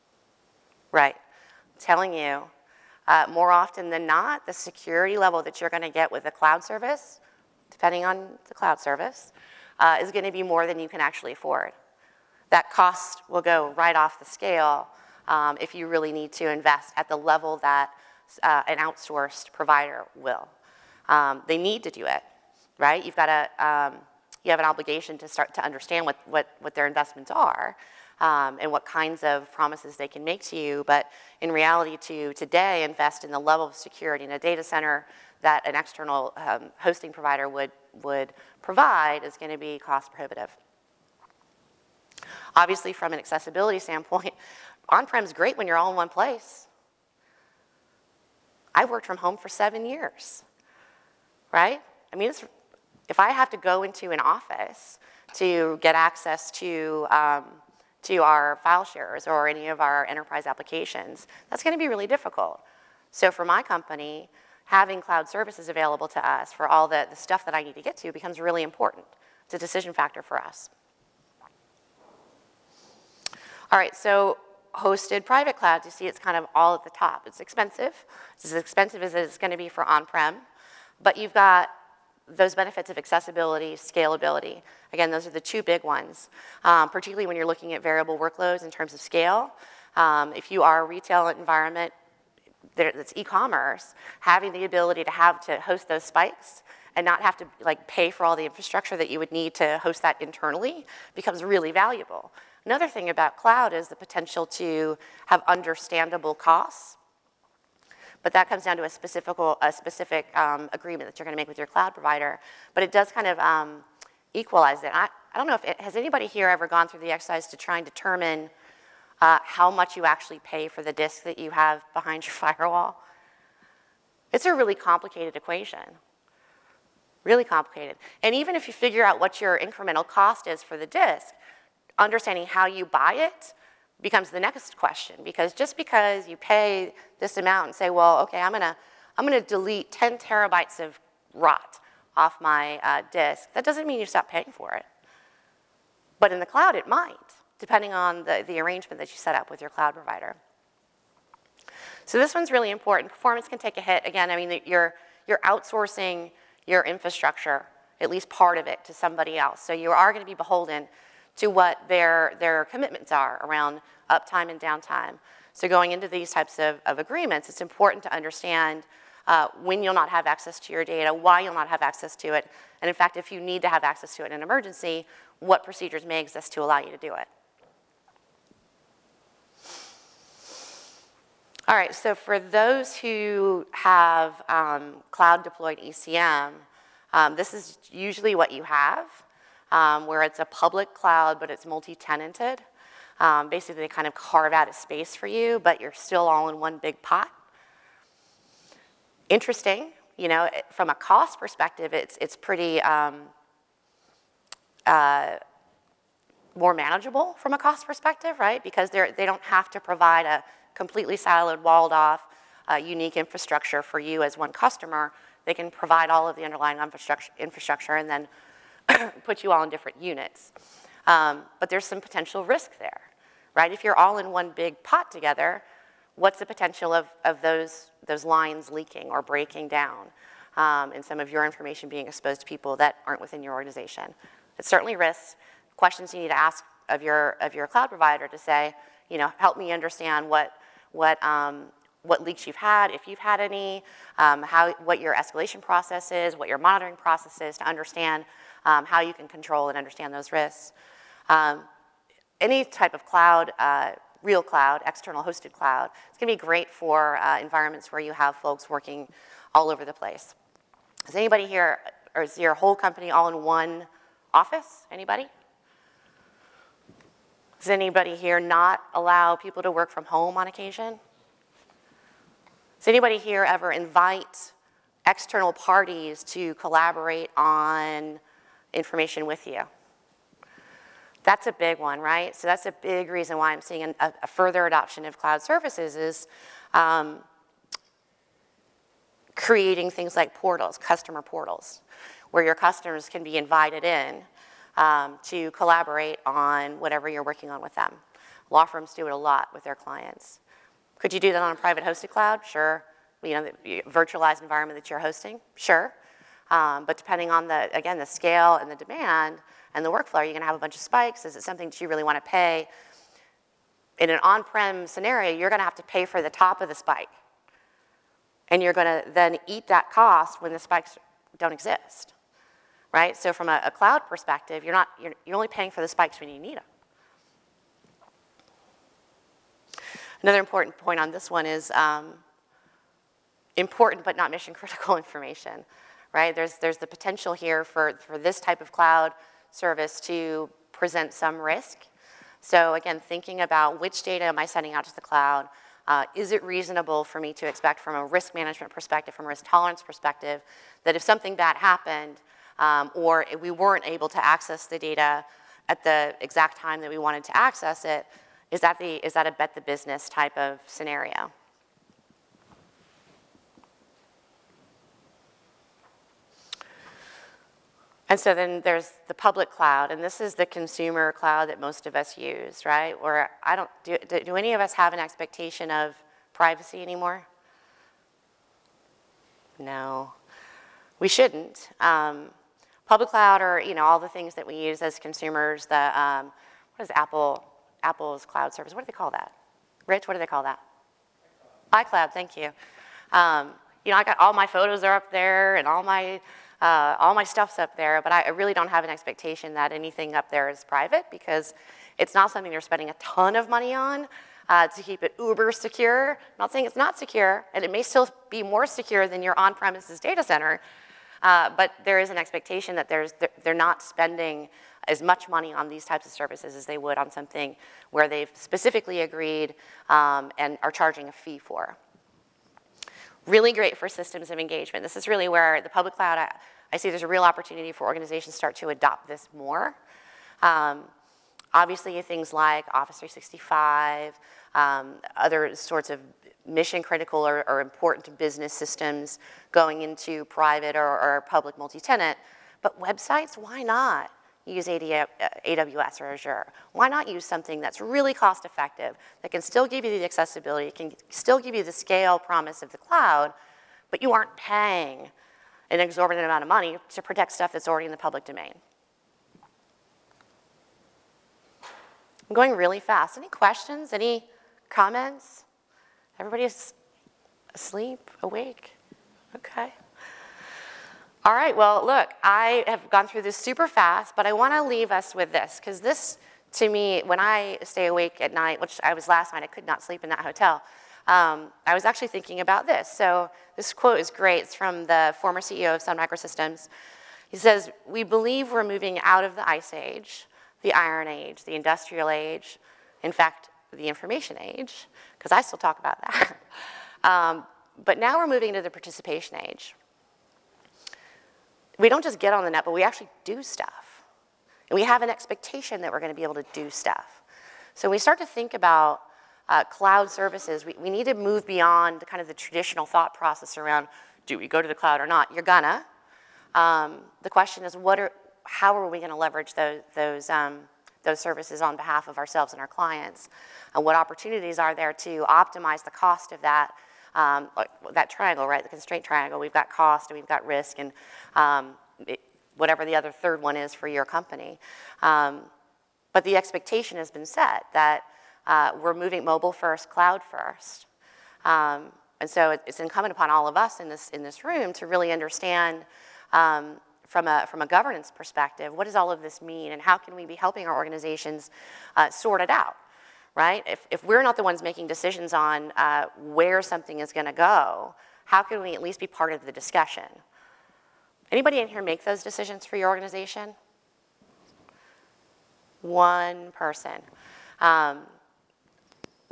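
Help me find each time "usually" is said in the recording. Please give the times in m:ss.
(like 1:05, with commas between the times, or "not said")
3:07.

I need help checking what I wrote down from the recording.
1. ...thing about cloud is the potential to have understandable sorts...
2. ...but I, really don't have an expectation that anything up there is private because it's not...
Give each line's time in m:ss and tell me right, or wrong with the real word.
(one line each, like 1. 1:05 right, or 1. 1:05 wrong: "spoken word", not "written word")
1. 1:42 wrong: "costs", not "sorts"
2. 6:38 right.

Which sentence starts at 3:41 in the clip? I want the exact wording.
Um, but there's some potential risk there, right?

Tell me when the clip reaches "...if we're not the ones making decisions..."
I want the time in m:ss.
9:13.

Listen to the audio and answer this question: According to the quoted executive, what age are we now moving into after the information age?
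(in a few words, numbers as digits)
The participation age.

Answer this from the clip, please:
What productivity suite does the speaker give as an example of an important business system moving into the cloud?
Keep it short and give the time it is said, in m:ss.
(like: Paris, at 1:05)
Office 365, at 7:12.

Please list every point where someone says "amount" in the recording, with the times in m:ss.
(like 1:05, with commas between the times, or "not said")
2:17, 7:36.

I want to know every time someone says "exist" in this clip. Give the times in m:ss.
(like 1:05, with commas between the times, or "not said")
2:56, 5:21.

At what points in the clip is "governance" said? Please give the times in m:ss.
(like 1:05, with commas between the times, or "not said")
9:07.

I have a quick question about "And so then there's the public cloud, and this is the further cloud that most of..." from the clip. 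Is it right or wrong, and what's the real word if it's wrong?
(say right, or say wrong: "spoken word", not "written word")
wrong: "consumer", not "further".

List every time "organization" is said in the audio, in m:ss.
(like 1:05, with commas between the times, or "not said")
3:53, 7:07, 9:10, 9:22.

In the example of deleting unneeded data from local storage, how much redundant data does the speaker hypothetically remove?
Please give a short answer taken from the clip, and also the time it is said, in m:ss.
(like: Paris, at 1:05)
10 terabytes, at 2:19.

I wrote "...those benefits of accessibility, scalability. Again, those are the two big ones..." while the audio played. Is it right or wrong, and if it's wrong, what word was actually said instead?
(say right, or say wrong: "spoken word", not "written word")
right.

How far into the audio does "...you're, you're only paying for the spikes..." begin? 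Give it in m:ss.
5:24.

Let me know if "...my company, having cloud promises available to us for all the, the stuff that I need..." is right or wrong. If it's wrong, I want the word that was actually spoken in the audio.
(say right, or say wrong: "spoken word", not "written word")
wrong: "services", not "promises".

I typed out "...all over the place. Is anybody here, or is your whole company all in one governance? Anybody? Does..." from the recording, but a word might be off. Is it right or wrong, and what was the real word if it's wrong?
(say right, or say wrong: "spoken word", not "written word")
wrong: "office", not "governance".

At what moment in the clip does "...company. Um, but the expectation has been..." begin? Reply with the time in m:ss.
8:54.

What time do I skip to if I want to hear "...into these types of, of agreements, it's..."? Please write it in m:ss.
2:45.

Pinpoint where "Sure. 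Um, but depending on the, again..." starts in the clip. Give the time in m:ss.
5:05.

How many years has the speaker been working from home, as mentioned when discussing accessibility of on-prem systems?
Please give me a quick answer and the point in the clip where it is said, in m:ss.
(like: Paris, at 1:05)
7, at 0:49.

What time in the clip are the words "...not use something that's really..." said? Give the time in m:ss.
7:26.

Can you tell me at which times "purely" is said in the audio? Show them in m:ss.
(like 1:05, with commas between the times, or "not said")
not said.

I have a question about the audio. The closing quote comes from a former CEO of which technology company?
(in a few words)
Sun Microsystems.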